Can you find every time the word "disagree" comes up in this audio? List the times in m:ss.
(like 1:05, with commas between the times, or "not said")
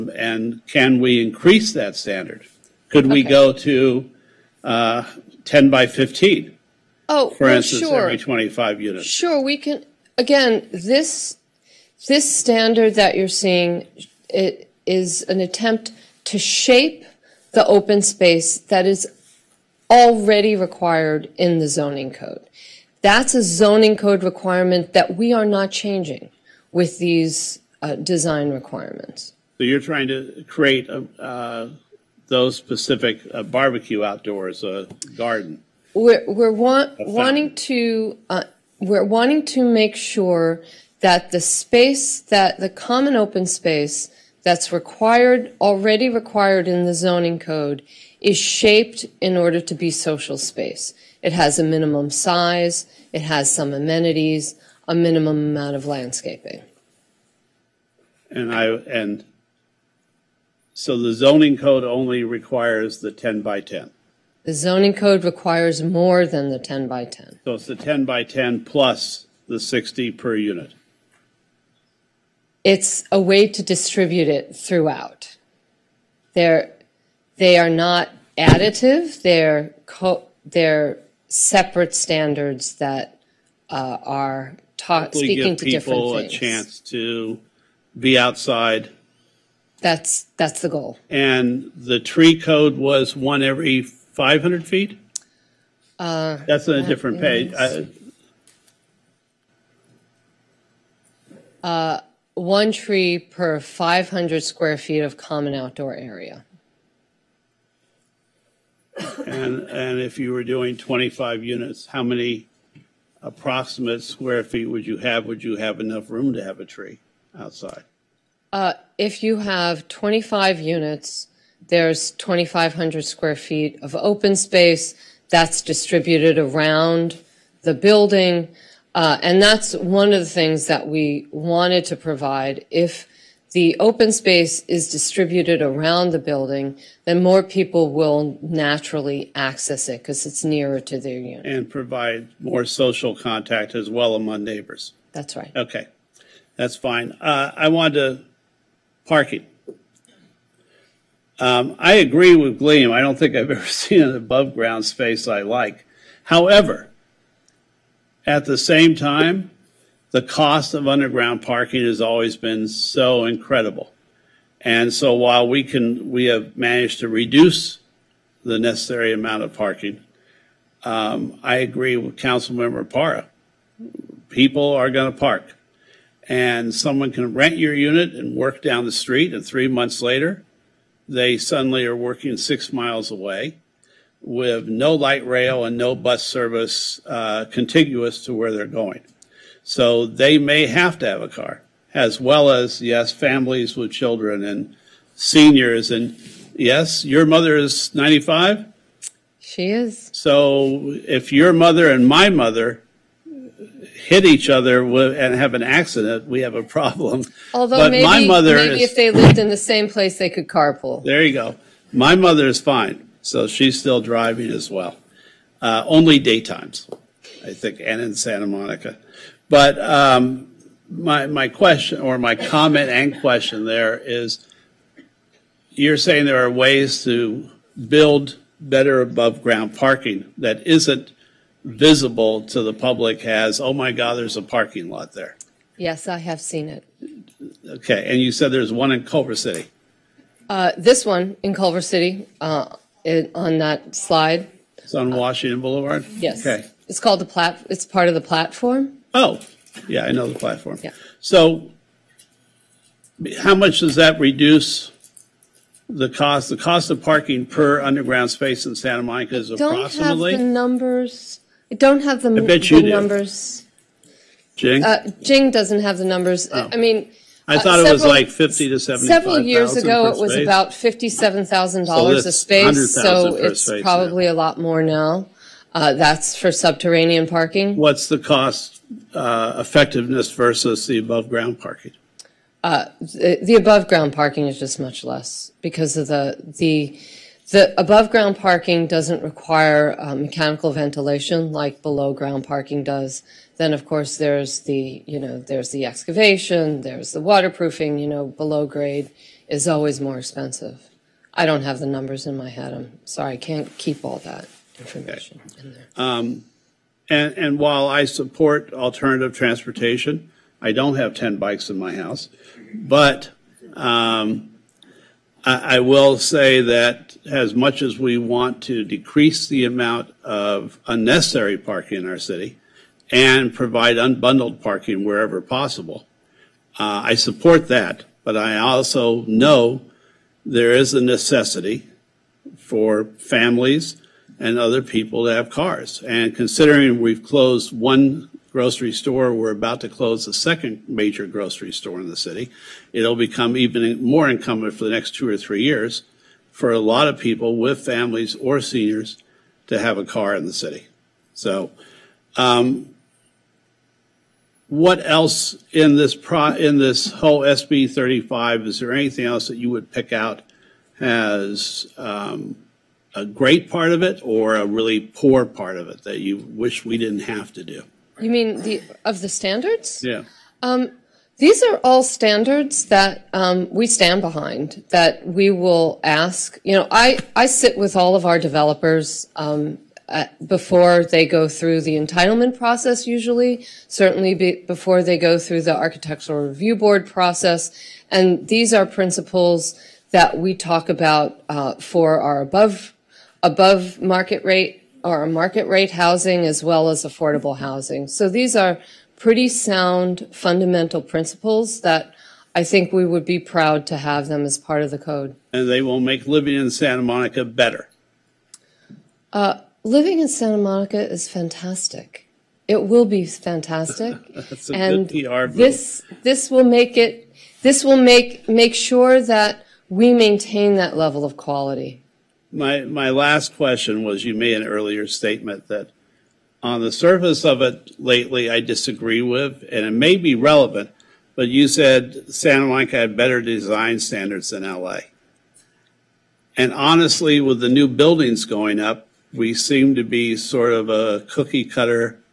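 7:08.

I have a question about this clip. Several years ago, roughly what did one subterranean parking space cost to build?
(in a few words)
$57,000.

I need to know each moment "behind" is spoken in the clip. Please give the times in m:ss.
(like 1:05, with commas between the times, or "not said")
6:14.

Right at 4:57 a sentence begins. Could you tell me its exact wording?
You know below grade is always more expensive.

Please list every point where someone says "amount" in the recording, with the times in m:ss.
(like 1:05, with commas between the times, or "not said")
0:55, 2:49, 5:19.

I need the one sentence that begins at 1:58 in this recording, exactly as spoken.
Uh, if you have 25 units, there's 2,500 square feet of open space that's distributed around the building.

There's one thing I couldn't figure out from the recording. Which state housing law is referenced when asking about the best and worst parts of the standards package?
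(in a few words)
SB 35.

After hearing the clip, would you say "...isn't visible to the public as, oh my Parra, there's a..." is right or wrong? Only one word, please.
wrong.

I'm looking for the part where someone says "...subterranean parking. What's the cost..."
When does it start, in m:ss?
4:36.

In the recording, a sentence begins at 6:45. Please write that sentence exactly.
And they will make living in Santa Monica better.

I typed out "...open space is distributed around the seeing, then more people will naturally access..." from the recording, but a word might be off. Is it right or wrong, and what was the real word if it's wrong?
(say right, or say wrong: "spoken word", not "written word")
wrong: "building", not "seeing".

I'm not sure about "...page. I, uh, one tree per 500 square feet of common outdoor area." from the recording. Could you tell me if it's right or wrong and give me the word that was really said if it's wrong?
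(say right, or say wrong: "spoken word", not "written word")
right.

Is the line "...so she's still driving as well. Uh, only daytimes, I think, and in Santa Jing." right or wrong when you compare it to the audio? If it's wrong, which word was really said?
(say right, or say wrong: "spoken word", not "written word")
wrong: "Monica", not "Jing".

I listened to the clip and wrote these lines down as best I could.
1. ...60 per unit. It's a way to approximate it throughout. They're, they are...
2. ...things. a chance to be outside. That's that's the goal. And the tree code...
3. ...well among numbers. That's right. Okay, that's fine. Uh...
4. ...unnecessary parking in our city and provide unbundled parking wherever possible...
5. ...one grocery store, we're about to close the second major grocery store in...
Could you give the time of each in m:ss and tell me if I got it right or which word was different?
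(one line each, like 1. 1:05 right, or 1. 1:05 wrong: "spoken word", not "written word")
1. 1:09 wrong: "distribute", not "approximate"
2. 1:26 right
3. 2:23 wrong: "neighbors", not "numbers"
4. 5:20 right
5. 5:37 right.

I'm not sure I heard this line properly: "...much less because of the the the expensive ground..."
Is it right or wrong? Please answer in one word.
wrong.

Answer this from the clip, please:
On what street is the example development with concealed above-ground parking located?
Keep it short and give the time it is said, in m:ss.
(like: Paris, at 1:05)
Washington Boulevard, at 4:05.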